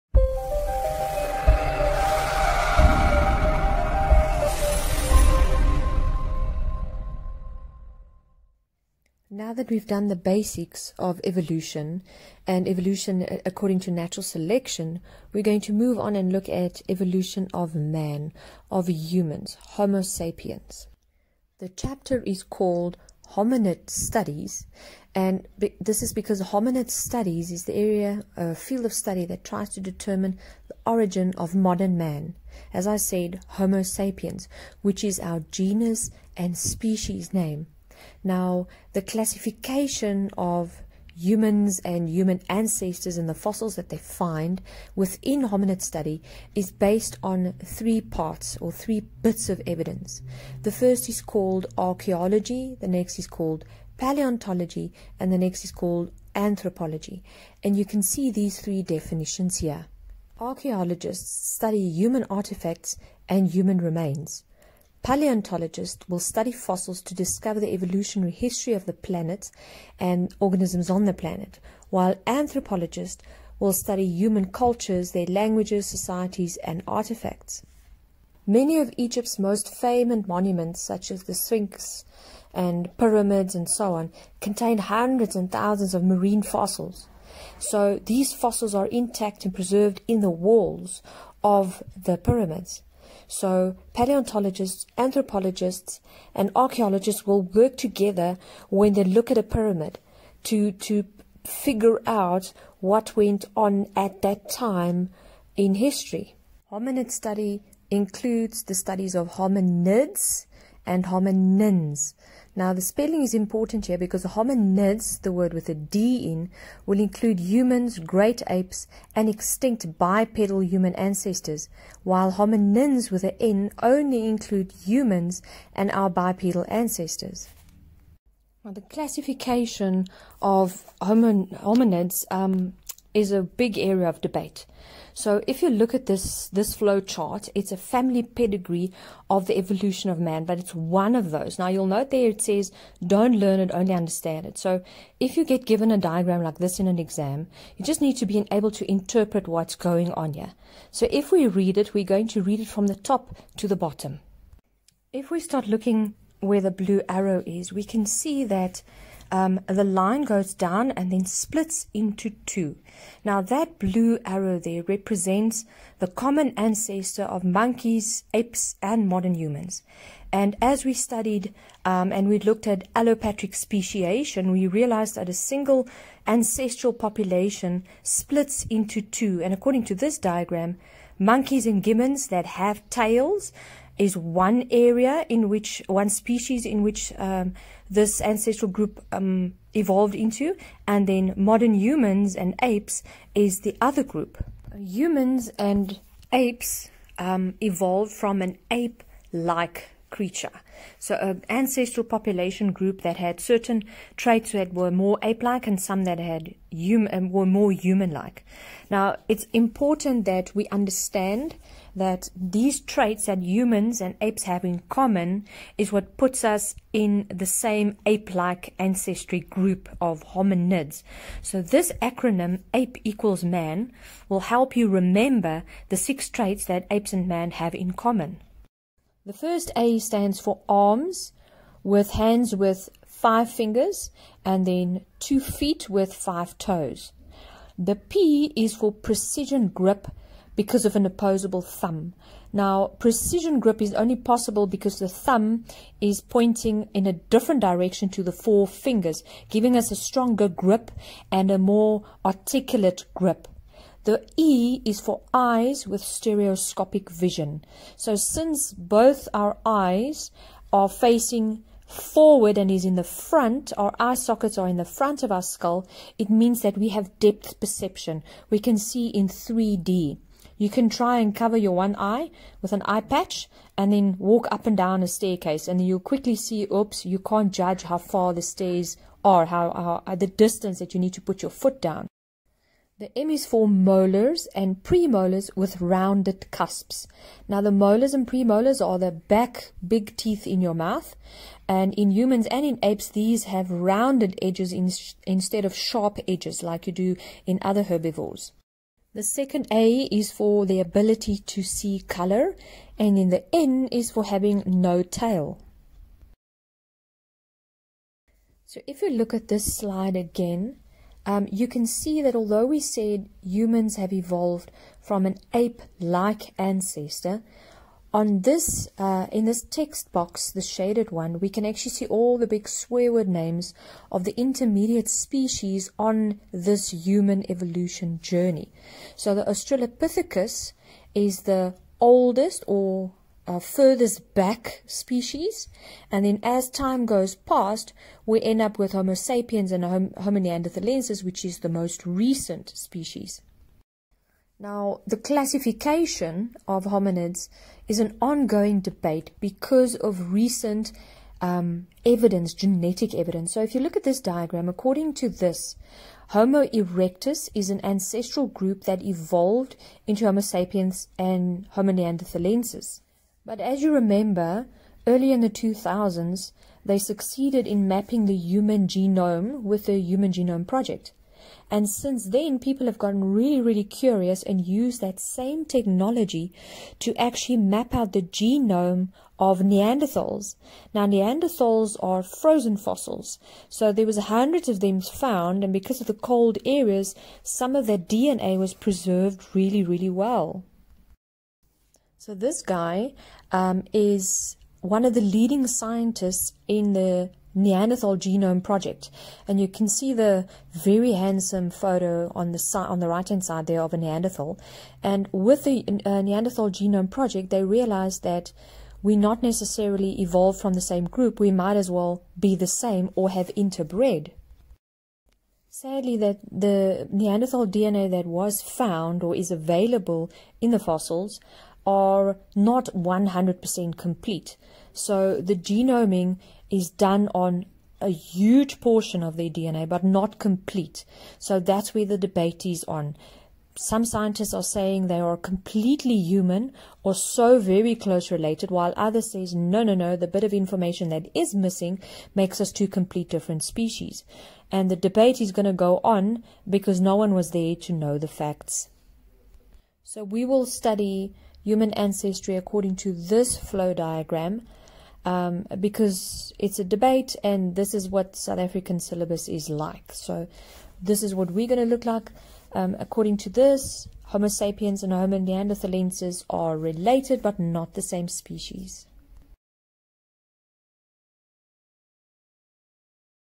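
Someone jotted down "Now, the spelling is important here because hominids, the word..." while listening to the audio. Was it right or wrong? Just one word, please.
right.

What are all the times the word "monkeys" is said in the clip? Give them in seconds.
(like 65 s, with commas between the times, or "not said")
167 s, 181 s.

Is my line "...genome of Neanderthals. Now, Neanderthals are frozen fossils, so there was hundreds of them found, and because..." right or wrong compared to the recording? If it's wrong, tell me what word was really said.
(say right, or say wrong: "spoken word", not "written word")
right.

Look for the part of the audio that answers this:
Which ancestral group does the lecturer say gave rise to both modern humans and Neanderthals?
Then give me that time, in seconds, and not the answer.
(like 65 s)
356 s.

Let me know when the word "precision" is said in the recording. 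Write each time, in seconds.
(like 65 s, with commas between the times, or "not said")
238 s, 242 s.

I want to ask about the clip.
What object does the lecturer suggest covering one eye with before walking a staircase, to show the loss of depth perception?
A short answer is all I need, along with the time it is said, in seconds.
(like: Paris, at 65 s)
eye patch, at 272 s.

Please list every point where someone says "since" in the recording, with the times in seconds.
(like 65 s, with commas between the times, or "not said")
258 s, 371 s.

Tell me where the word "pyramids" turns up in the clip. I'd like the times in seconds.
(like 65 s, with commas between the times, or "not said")
82 s, 92 s, 99 s.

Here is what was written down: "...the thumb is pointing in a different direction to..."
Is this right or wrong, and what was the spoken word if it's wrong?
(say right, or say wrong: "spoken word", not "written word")
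right.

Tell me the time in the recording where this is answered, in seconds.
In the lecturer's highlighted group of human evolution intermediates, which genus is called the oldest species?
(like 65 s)
329 s.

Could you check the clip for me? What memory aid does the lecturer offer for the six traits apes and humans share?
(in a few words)
APE equals man.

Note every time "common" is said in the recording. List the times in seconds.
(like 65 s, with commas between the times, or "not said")
166 s, 214 s, 227 s.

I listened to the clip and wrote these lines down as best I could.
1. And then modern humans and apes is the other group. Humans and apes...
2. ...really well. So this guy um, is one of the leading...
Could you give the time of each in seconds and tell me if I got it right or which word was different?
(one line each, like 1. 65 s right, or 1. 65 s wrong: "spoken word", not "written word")
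1. 190 s right
2. 389 s right.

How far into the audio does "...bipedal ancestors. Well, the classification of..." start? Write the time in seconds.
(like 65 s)
126 s.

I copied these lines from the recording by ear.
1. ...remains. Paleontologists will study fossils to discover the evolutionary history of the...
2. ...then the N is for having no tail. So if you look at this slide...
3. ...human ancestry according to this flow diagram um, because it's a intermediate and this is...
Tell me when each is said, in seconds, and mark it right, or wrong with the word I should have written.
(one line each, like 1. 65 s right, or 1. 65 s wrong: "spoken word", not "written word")
1. 63 s right
2. 303 s right
3. 451 s wrong: "debate", not "intermediate".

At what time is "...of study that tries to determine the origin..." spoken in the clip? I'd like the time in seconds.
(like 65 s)
28 s.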